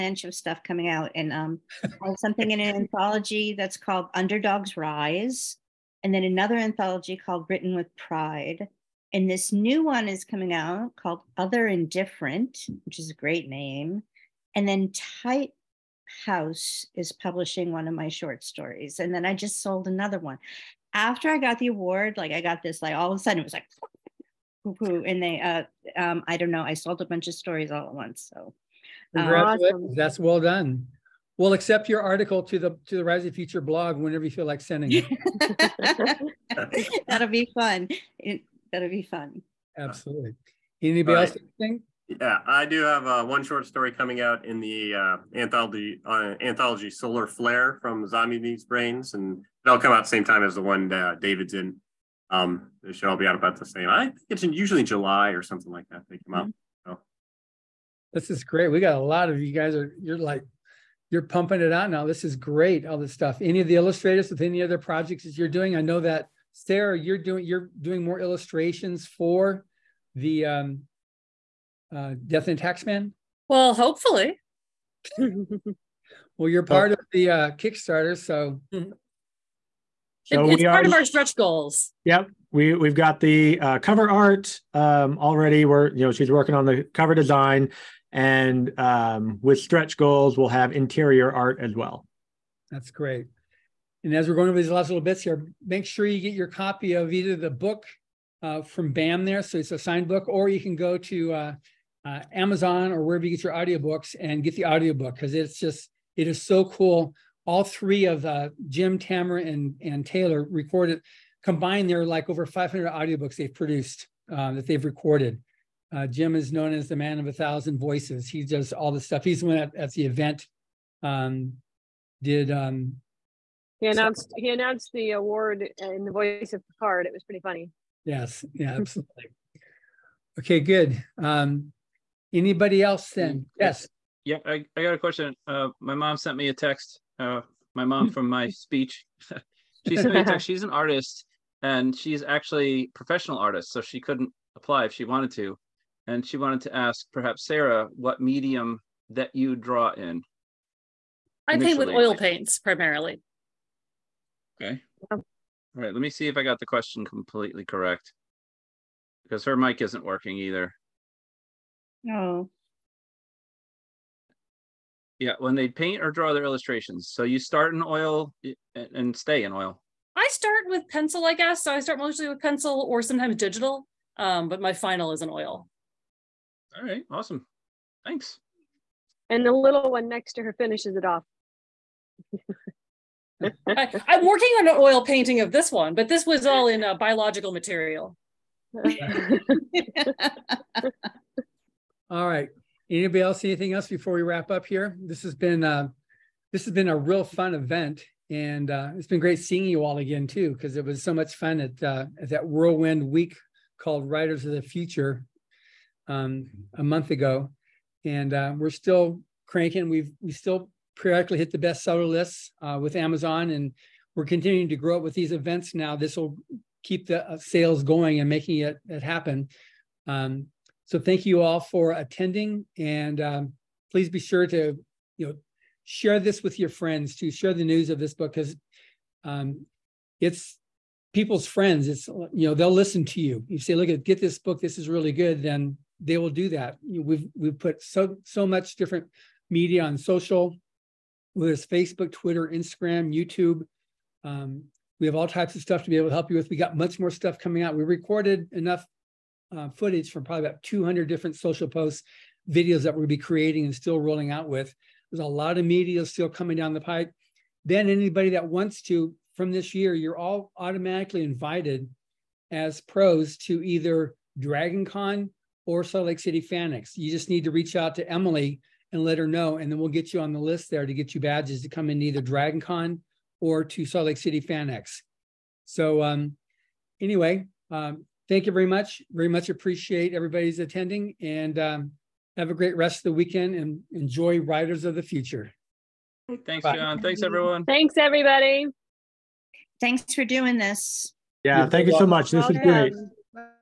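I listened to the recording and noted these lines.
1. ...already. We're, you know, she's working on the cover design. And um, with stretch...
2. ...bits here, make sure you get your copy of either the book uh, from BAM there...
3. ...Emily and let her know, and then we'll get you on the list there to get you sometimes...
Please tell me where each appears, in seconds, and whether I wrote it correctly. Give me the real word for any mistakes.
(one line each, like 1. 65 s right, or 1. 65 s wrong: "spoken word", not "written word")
1. 85 s right
2. 95 s right
3. 268 s wrong: "badges", not "sometimes".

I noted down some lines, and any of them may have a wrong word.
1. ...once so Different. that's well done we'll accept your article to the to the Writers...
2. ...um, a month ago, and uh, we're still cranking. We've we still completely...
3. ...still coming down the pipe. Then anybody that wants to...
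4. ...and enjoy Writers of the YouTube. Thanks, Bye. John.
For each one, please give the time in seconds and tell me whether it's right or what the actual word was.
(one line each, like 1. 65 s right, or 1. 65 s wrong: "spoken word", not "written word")
1. 27 s wrong: "Congratulations", not "Different"
2. 206 s wrong: "periodically", not "completely"
3. 256 s right
4. 283 s wrong: "Future", not "YouTube".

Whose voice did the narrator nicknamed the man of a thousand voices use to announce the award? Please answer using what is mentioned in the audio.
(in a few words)
Picard.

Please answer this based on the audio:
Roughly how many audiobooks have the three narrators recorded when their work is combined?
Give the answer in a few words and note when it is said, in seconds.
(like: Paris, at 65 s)
over 500, at 112 s.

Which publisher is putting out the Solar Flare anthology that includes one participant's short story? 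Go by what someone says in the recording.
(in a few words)
Zombies Need Brains.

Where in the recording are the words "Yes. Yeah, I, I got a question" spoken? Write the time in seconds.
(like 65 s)
133 s.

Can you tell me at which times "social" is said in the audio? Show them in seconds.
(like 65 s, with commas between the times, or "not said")
239 s, 251 s.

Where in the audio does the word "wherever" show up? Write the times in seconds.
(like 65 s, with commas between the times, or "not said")
103 s.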